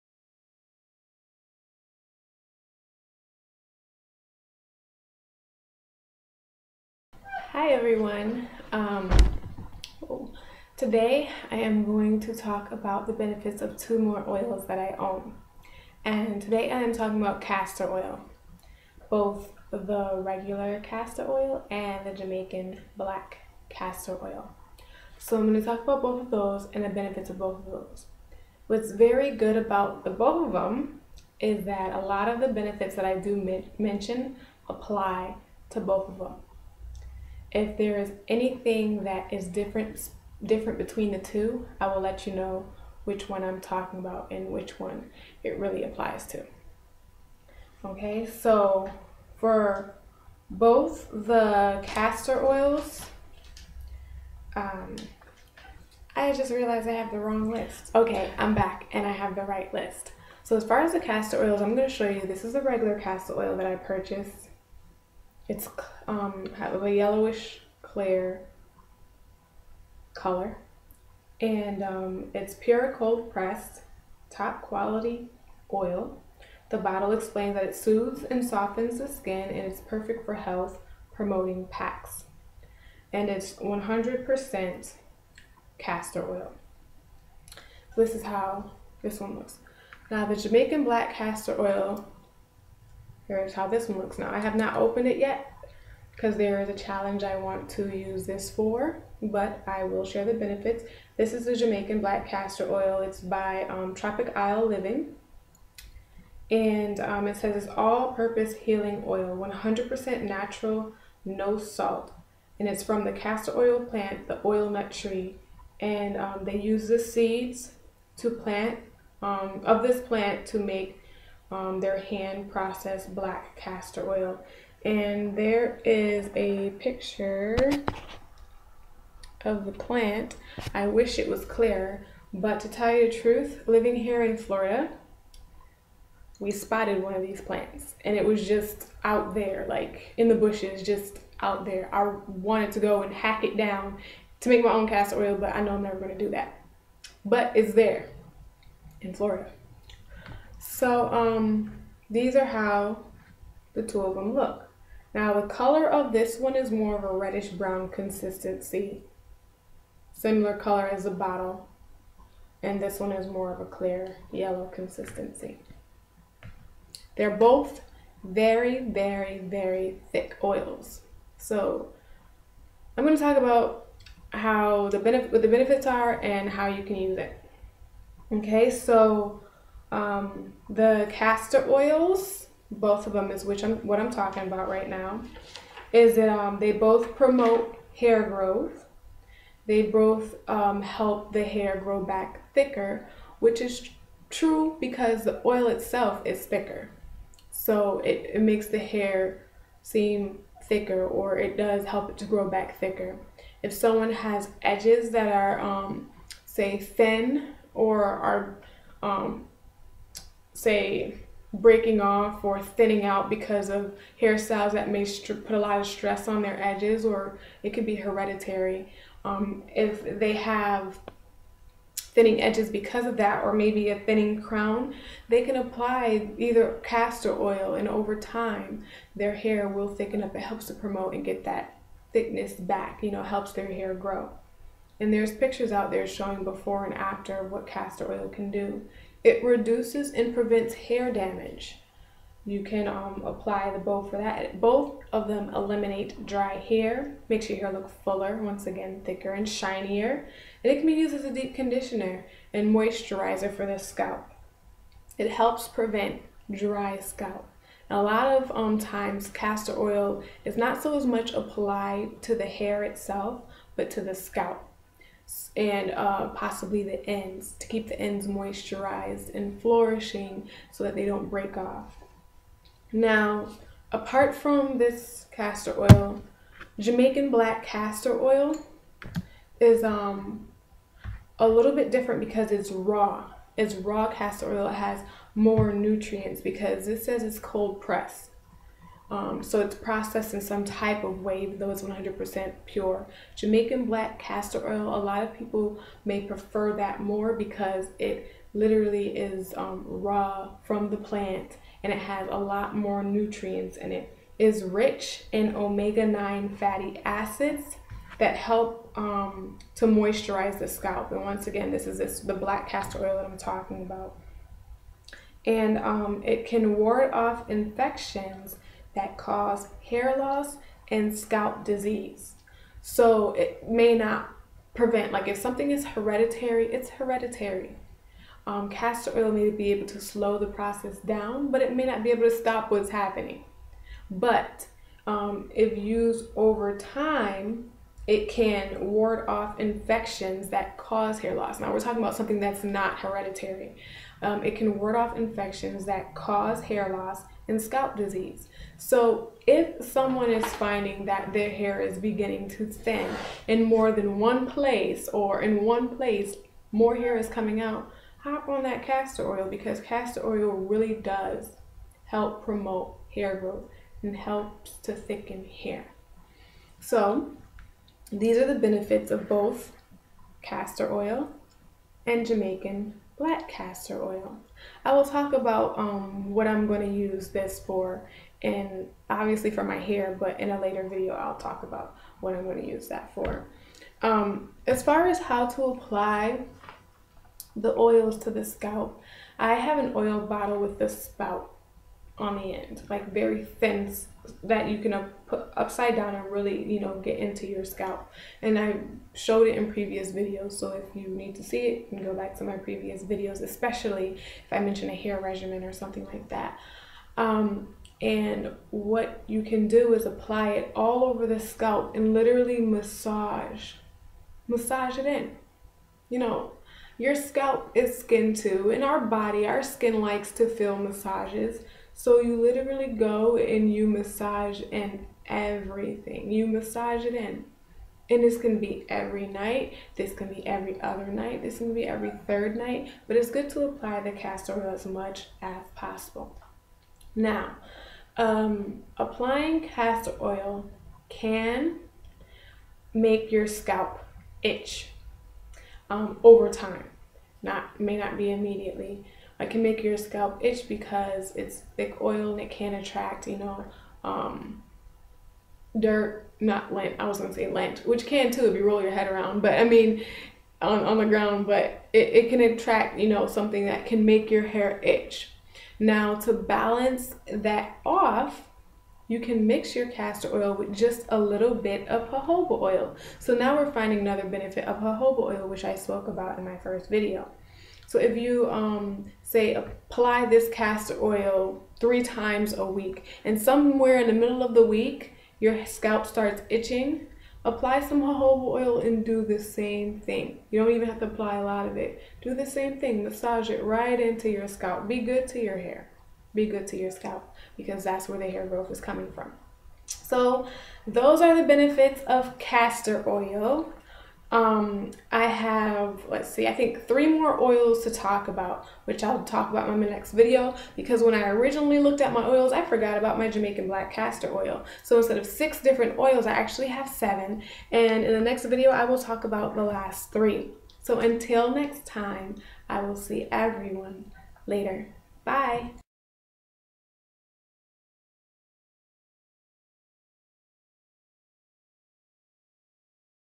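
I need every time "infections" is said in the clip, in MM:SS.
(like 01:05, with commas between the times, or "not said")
05:17, 05:39, 05:45.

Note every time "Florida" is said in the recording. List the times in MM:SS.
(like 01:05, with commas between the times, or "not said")
02:14, 02:29.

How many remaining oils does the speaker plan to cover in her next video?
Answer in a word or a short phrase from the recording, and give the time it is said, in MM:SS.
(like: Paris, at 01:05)
3, at 08:39.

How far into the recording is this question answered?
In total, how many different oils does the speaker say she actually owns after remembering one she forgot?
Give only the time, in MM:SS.
08:36.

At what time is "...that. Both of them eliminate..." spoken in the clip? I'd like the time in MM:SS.
04:04.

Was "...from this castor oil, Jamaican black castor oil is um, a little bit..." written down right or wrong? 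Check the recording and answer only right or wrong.
right.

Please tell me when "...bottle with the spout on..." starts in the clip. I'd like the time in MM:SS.
06:30.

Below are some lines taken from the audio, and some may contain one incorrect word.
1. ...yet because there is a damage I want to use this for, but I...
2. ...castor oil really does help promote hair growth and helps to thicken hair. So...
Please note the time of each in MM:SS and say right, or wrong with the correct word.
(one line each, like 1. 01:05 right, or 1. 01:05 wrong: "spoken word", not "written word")
1. 01:35 wrong: "challenge", not "damage"
2. 05:59 right.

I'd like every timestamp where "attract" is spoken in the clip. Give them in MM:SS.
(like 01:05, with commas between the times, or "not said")
07:32, 07:42.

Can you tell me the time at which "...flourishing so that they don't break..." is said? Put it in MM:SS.
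04:29.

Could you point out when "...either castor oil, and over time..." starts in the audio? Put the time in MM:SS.
03:46.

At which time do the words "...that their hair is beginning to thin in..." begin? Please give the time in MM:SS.
05:51.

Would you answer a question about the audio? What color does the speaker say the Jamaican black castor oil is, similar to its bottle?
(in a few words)
reddish brown.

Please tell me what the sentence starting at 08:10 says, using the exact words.
You don't even have to apply a lot of it.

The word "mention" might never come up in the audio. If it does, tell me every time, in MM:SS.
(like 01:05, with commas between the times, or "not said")
00:33, 06:44.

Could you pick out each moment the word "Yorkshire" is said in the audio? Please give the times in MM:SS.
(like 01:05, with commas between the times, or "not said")
not said.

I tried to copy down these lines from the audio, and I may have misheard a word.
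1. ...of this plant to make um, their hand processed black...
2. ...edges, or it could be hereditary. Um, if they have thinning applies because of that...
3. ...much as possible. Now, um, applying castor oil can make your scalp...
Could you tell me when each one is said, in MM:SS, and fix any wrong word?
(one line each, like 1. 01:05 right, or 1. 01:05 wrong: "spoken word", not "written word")
1. 01:59 right
2. 03:36 wrong: "edges", not "applies"
3. 07:14 right.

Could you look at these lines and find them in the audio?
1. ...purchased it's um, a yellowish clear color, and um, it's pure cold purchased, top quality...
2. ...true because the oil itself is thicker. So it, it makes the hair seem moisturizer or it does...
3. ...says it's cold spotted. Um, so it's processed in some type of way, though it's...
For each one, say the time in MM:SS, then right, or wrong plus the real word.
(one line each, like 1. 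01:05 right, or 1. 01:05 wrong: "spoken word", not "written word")
1. 01:03 wrong: "pressed", not "purchased"
2. 03:14 wrong: "thicker", not "moisturizer"
3. 04:47 wrong: "pressed", not "spotted".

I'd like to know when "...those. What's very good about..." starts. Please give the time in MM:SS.
00:27.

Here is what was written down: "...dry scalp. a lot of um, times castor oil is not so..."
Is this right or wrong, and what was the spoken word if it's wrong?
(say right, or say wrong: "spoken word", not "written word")
right.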